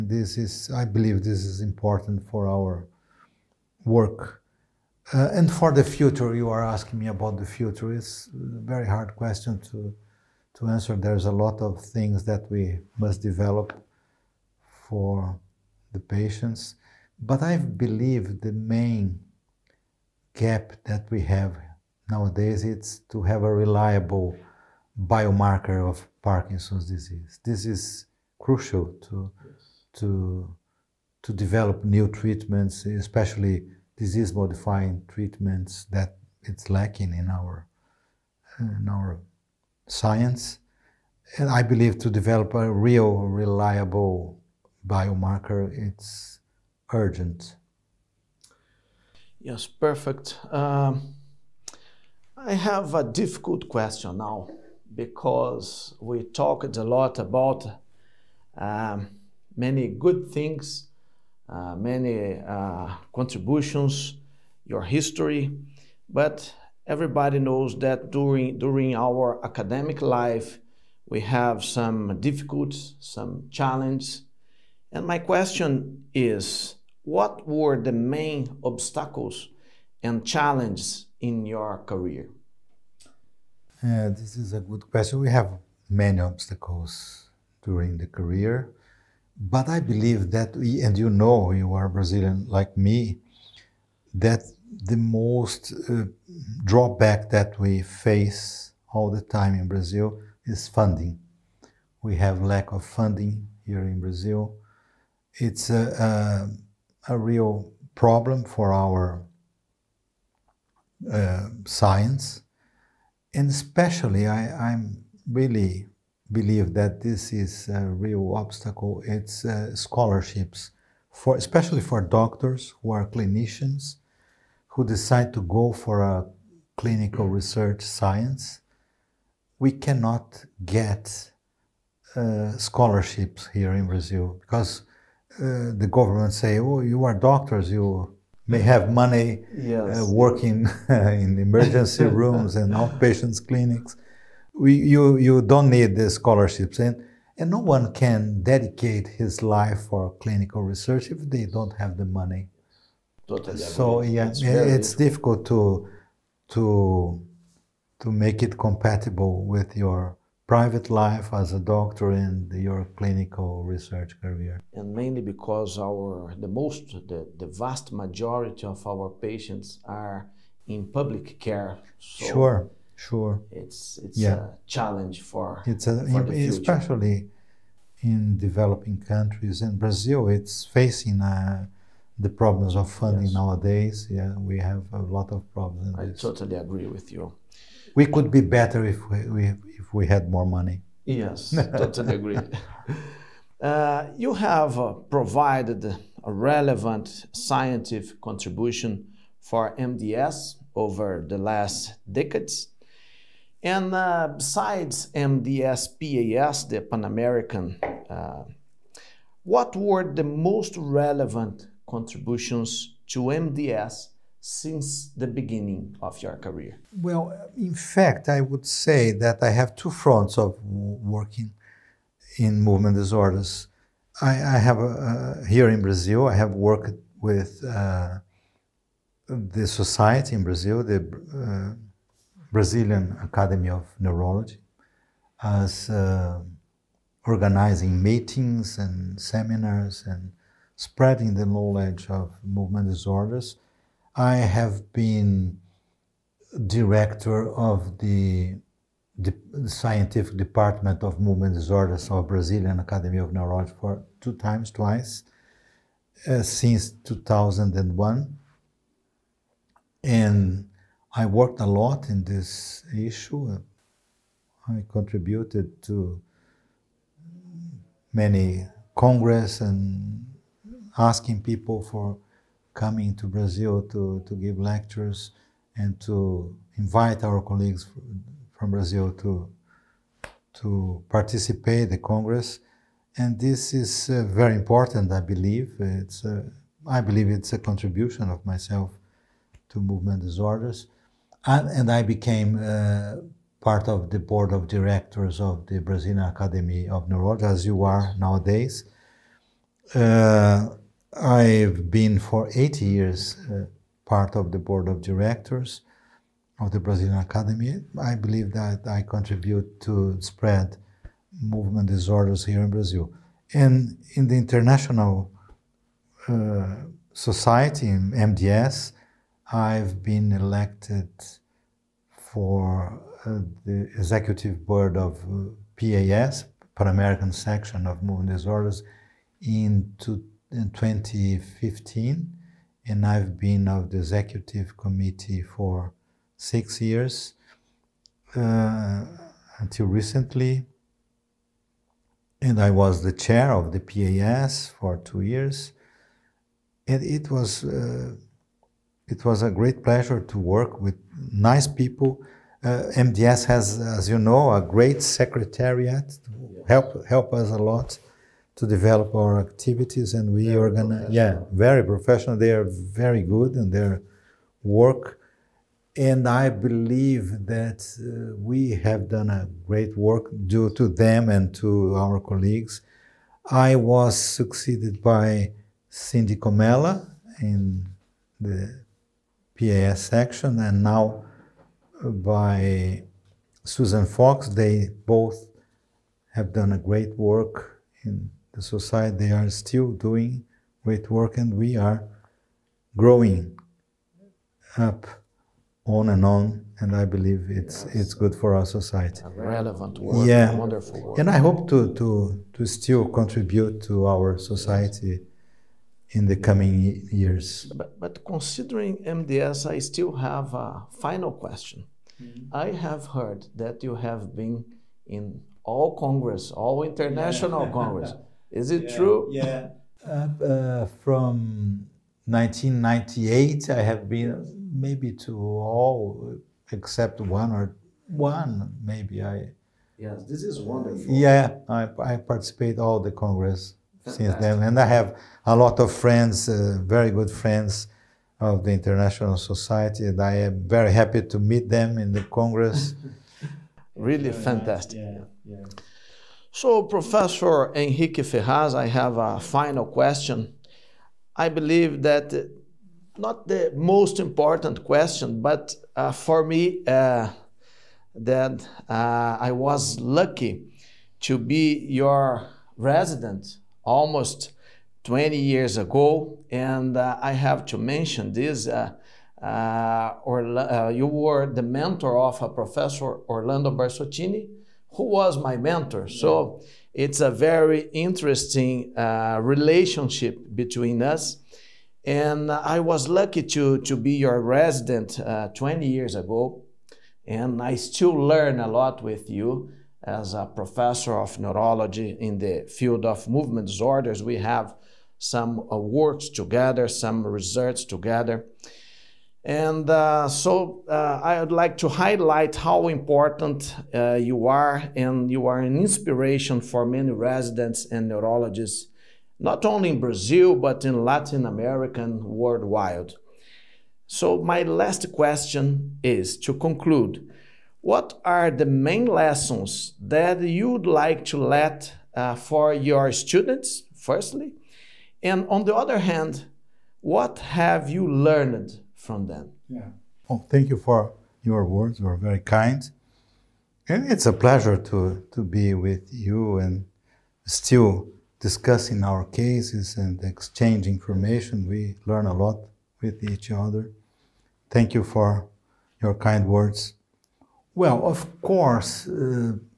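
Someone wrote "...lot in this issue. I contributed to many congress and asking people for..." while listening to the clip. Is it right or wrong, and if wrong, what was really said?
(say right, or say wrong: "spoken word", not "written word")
right.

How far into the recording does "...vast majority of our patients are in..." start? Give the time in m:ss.
2:47.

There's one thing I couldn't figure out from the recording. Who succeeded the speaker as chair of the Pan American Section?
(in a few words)
Cindy Comella.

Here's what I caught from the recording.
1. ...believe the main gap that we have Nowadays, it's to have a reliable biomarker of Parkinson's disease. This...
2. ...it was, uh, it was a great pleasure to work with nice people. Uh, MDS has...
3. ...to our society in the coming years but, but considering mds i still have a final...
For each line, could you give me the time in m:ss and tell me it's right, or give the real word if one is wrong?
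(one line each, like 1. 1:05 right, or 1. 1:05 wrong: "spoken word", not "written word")
1. 0:17 right
2. 5:47 right
3. 6:43 right.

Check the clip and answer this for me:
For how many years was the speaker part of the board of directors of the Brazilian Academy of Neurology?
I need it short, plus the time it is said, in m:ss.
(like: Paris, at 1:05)
8, at 5:02.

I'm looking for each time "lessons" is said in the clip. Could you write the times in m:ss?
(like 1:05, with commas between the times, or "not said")
8:39.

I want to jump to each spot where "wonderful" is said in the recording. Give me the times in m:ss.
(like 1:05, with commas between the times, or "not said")
6:40, 7:10.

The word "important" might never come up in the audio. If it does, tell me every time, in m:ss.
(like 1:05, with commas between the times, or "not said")
0:01, 4:44, 7:34, 8:22.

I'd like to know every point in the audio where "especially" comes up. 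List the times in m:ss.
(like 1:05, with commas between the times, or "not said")
0:32, 1:53, 2:01, 2:56.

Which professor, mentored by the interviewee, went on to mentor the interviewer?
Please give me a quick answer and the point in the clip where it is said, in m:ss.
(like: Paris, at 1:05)
Orlando Barsottini, at 7:53.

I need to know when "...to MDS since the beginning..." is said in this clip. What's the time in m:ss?
3:33.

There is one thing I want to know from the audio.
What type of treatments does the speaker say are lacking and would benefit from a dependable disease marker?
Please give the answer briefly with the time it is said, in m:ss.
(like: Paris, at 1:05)
Disease modifying treatments, at 0:33.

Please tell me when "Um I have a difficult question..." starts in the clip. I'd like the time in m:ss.
0:50.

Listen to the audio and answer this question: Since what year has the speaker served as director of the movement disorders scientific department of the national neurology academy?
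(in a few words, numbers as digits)
2001.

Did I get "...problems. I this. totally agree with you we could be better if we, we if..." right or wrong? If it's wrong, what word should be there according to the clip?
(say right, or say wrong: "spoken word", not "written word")
right.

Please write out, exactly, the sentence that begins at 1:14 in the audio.
And my question is, what were the main obstacles and challenges in your career?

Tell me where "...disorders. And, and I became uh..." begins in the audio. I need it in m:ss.
4:50.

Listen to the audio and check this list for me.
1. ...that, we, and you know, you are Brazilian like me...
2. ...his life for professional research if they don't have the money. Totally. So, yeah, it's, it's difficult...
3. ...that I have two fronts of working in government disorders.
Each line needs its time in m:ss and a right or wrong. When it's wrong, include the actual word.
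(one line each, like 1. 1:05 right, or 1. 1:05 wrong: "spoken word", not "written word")
1. 1:30 right
2. 2:29 wrong: "clinical", not "professional"
3. 3:39 wrong: "movement", not "government".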